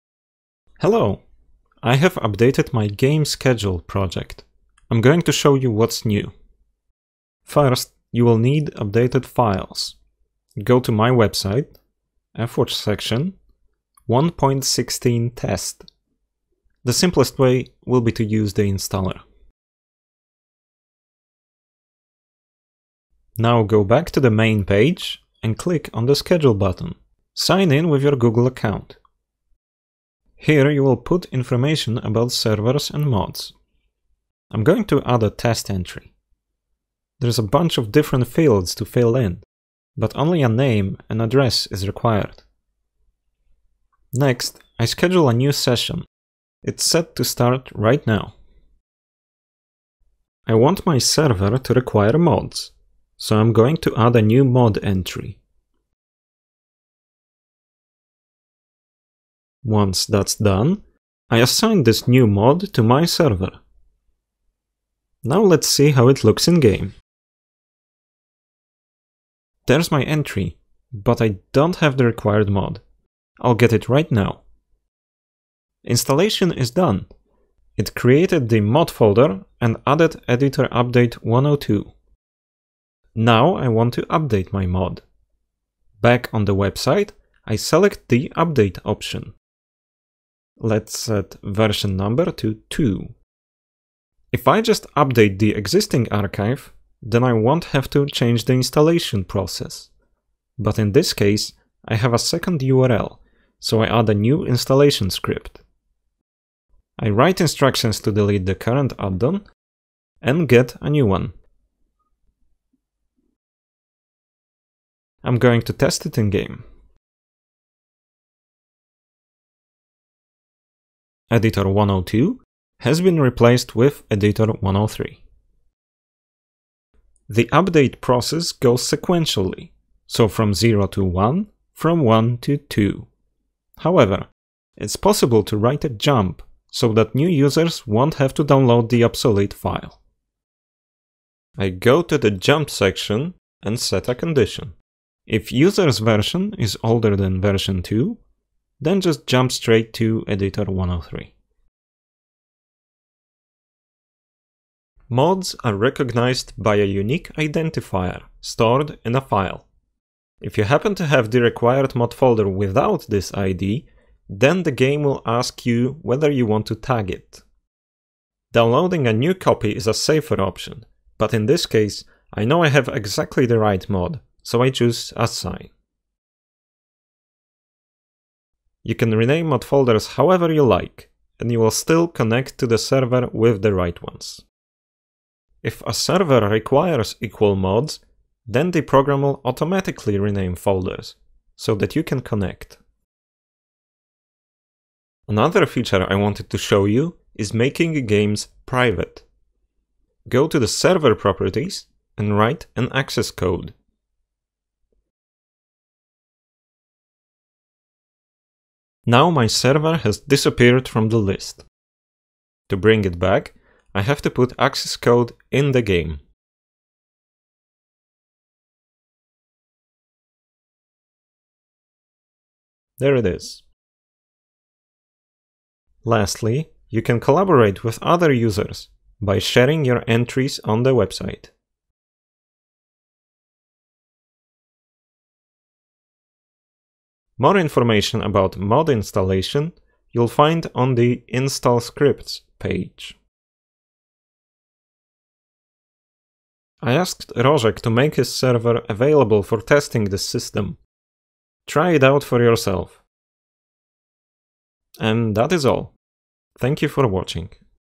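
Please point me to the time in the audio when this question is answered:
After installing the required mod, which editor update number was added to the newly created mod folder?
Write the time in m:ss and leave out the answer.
1:20.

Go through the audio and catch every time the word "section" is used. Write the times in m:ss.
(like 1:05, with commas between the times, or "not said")
0:12, 2:22.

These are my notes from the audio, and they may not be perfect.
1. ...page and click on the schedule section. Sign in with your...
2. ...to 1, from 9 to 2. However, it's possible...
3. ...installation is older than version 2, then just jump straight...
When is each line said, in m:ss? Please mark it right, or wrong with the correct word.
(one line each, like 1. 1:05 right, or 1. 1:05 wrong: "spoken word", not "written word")
1. 0:24 wrong: "button", not "section"
2. 2:10 wrong: "1", not "9"
3. 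2:25 wrong: "version", not "installation".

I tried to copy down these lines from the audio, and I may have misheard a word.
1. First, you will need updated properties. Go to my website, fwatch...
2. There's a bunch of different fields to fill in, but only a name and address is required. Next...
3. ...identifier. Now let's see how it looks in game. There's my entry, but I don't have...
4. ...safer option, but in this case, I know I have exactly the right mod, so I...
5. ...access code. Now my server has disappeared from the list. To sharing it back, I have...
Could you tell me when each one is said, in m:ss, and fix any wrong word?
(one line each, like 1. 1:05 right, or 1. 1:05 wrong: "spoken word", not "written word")
1. 0:07 wrong: "files", not "properties"
2. 0:37 right
3. 1:03 wrong: "server", not "identifier"
4. 2:49 right
5. 3:22 wrong: "bring", not "sharing".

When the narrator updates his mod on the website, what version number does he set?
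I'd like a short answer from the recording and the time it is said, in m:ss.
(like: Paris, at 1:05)
2, at 1:31.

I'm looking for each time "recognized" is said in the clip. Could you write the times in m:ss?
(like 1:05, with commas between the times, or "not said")
2:35.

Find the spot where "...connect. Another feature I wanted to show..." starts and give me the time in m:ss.
3:12.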